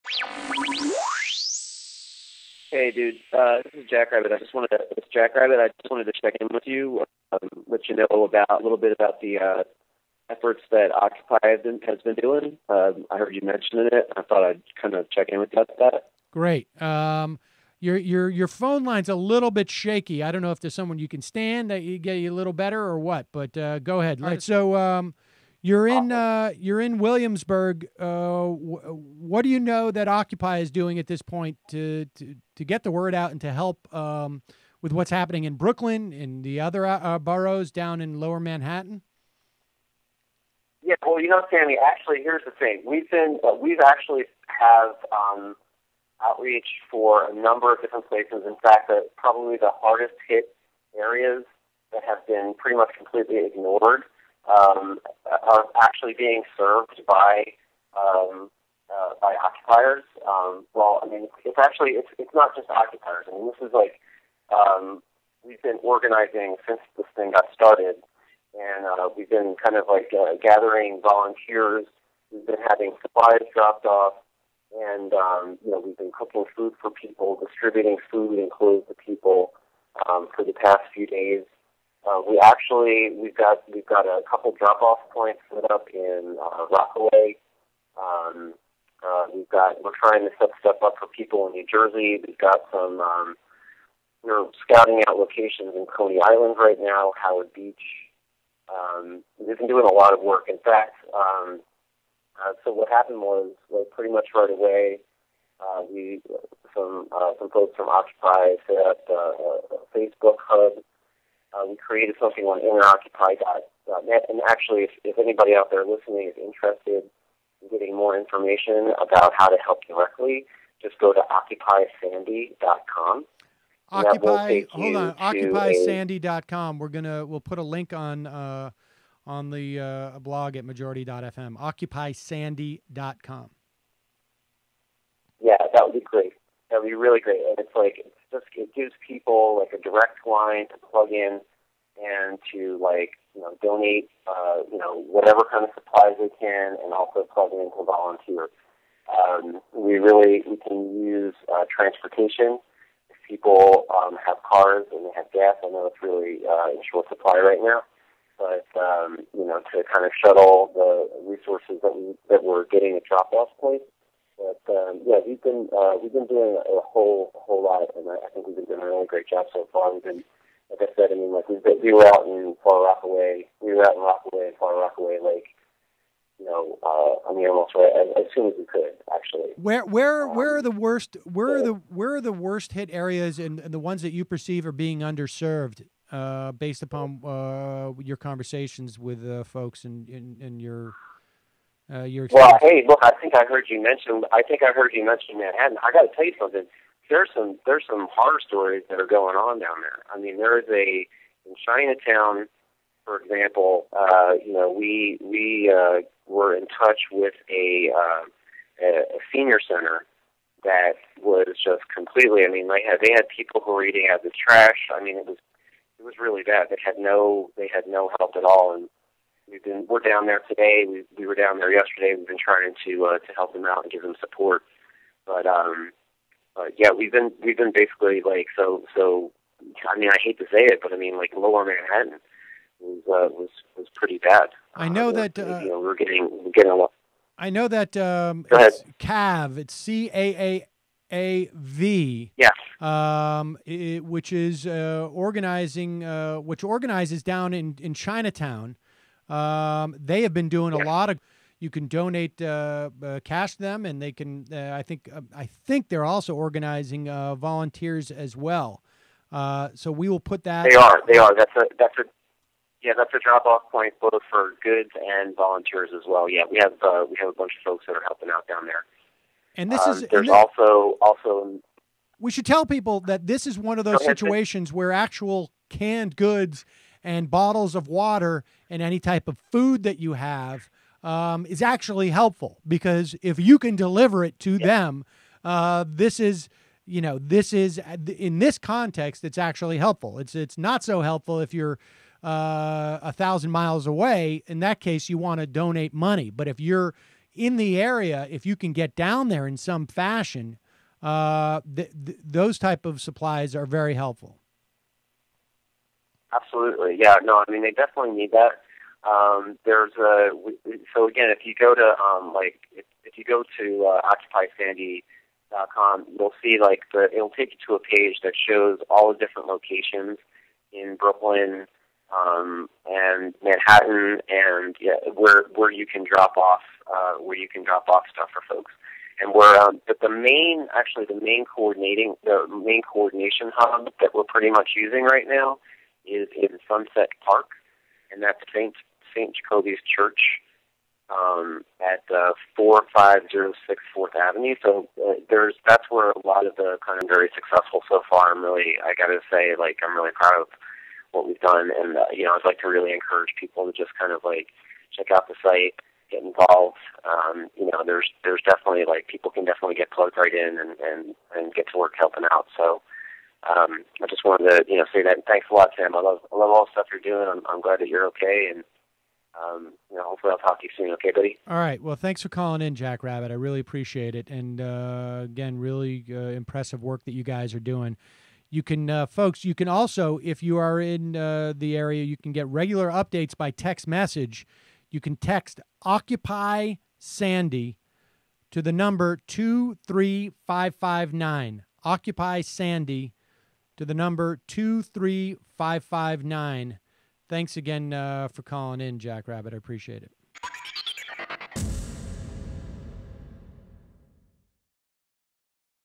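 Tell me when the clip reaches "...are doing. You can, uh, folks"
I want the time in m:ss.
6:17.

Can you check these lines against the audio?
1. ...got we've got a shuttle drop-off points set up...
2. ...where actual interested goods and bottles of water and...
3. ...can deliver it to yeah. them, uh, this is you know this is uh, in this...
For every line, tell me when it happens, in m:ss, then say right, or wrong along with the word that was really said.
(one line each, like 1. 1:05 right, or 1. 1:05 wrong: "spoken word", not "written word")
1. 1:23 wrong: "couple", not "shuttle"
2. 4:34 wrong: "canned", not "interested"
3. 4:43 right.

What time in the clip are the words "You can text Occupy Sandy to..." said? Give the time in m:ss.
6:24.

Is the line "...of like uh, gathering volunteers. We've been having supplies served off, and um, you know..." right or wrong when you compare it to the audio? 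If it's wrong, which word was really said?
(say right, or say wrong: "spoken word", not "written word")
wrong: "dropped", not "served".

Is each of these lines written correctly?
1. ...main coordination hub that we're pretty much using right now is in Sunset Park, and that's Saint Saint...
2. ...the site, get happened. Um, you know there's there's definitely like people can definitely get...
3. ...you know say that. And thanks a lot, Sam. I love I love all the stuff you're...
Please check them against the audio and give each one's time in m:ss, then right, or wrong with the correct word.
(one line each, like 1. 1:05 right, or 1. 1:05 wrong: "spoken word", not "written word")
1. 5:32 right
2. 5:55 wrong: "involved", not "happened"
3. 6:04 right.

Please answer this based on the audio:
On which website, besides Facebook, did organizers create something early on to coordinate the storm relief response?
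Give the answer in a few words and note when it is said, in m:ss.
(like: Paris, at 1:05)
interoccupy.net, at 1:52.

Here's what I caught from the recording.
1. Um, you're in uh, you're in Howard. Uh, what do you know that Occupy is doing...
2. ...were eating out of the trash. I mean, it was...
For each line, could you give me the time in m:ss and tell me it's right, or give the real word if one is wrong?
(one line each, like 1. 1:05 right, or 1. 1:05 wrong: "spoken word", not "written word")
1. 0:24 wrong: "Williamsburg", not "Howard"
2. 3:33 right.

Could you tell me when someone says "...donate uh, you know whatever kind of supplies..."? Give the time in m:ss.
2:23.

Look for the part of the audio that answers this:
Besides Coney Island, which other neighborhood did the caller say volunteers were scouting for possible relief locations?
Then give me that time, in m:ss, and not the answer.
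1:37.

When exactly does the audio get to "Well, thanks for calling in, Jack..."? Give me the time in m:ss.
6:11.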